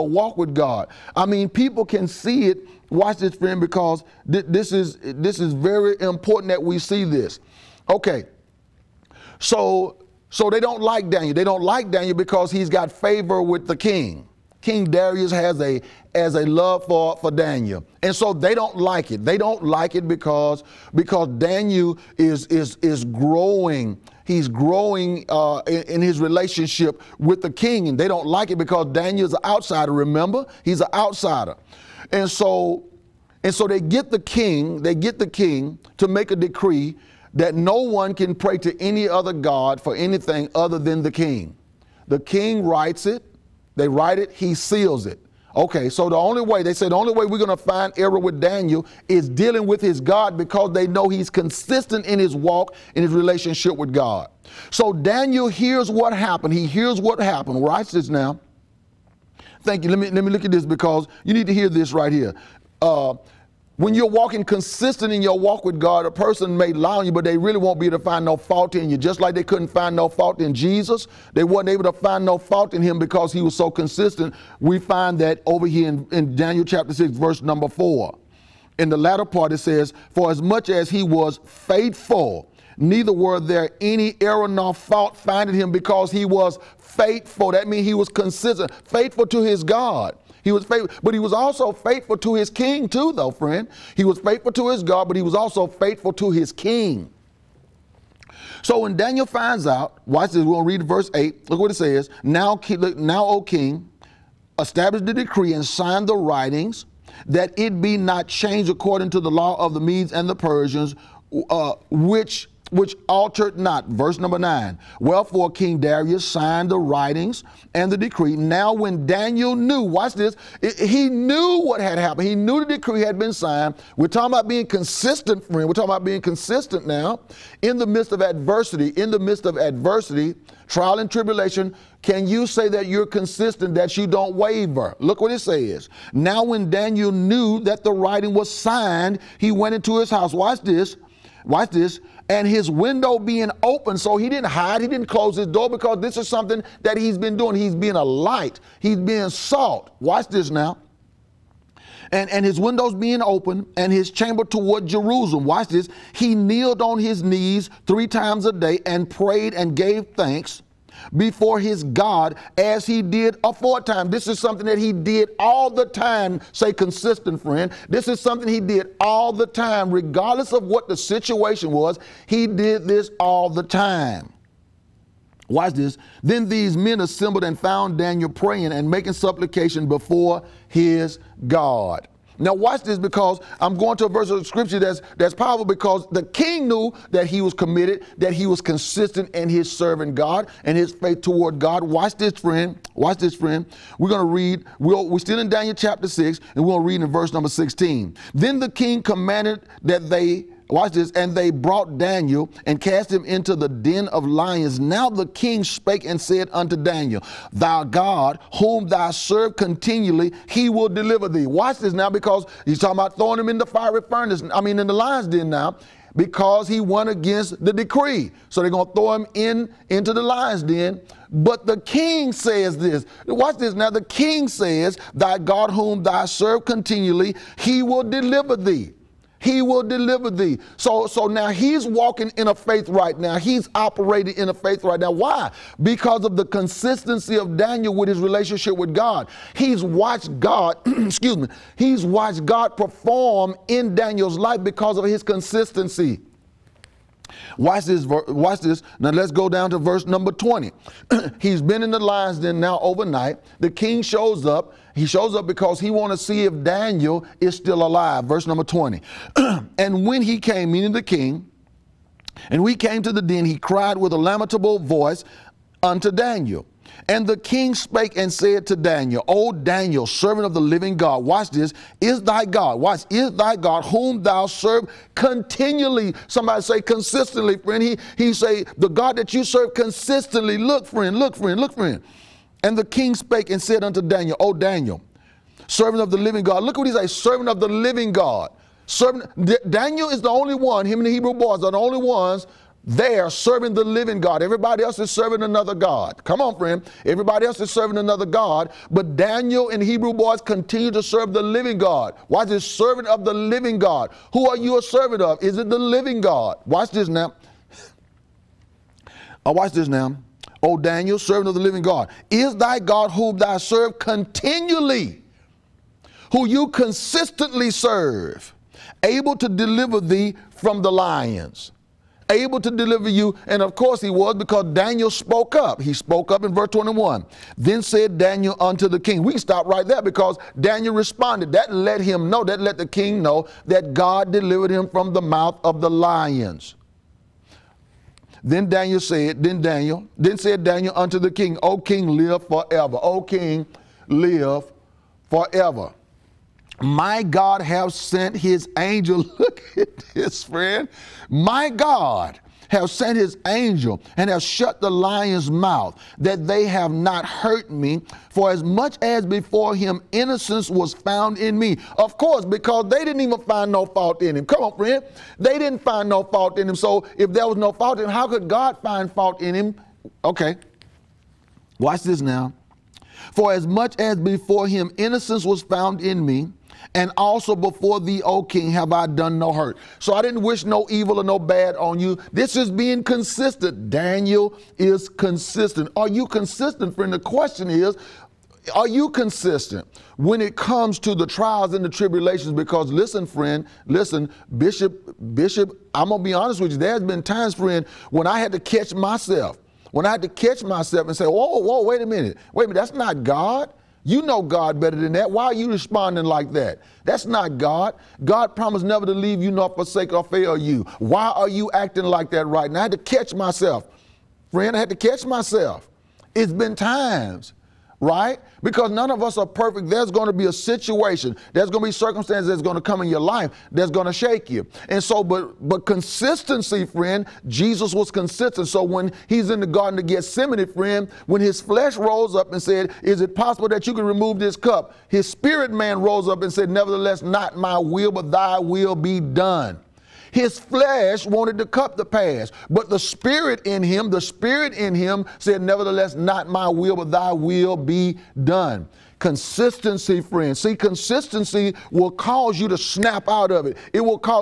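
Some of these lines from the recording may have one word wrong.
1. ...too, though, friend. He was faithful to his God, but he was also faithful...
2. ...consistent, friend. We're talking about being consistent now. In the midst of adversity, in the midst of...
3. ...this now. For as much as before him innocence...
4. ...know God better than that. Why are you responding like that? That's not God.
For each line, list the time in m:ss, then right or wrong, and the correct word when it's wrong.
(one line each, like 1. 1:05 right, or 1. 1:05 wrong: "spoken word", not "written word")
1. 1:32 right
2. 2:04 right
3. 6:12 right
4. 6:44 right.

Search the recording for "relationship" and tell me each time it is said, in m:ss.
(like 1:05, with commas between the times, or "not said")
0:26, 0:53, 3:58.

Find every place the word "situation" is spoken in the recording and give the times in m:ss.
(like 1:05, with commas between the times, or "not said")
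2:50, 7:00.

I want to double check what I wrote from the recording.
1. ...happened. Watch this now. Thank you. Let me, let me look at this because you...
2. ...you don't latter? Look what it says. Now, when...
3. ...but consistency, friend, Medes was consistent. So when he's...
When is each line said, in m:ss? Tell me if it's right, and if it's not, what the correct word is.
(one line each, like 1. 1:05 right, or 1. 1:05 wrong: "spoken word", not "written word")
1. 0:57 right
2. 2:13 wrong: "waver", not "latter"
3. 7:05 wrong: "Jesus", not "Medes".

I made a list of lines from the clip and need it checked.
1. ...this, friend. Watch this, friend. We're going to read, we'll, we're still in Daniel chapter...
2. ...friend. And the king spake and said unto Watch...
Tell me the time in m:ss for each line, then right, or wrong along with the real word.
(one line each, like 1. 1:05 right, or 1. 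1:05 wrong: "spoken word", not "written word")
1. 3:12 right
2. 4:41 wrong: "Daniel", not "Watch".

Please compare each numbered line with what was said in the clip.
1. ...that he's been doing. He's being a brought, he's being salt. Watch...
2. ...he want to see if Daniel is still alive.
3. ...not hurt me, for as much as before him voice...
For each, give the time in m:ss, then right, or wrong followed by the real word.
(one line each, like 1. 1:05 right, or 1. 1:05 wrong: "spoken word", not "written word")
1. 2:26 wrong: "light", not "brought"
2. 4:15 right
3. 5:56 wrong: "innocence", not "voice".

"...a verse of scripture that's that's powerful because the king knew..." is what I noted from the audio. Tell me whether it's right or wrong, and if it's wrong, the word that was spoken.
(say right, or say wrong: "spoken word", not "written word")
right.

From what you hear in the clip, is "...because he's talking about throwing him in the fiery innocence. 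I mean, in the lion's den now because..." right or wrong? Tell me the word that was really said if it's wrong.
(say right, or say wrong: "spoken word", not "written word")
wrong: "furnace", not "innocence".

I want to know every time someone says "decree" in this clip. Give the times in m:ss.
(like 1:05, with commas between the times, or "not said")
0:36, 1:45, 1:57, 2:02, 3:37.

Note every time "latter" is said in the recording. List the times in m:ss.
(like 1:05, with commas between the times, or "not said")
1:18.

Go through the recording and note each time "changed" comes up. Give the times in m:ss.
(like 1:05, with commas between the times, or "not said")
1:48.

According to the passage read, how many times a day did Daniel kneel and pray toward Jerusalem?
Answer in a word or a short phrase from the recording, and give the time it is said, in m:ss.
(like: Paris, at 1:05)
3, at 2:37.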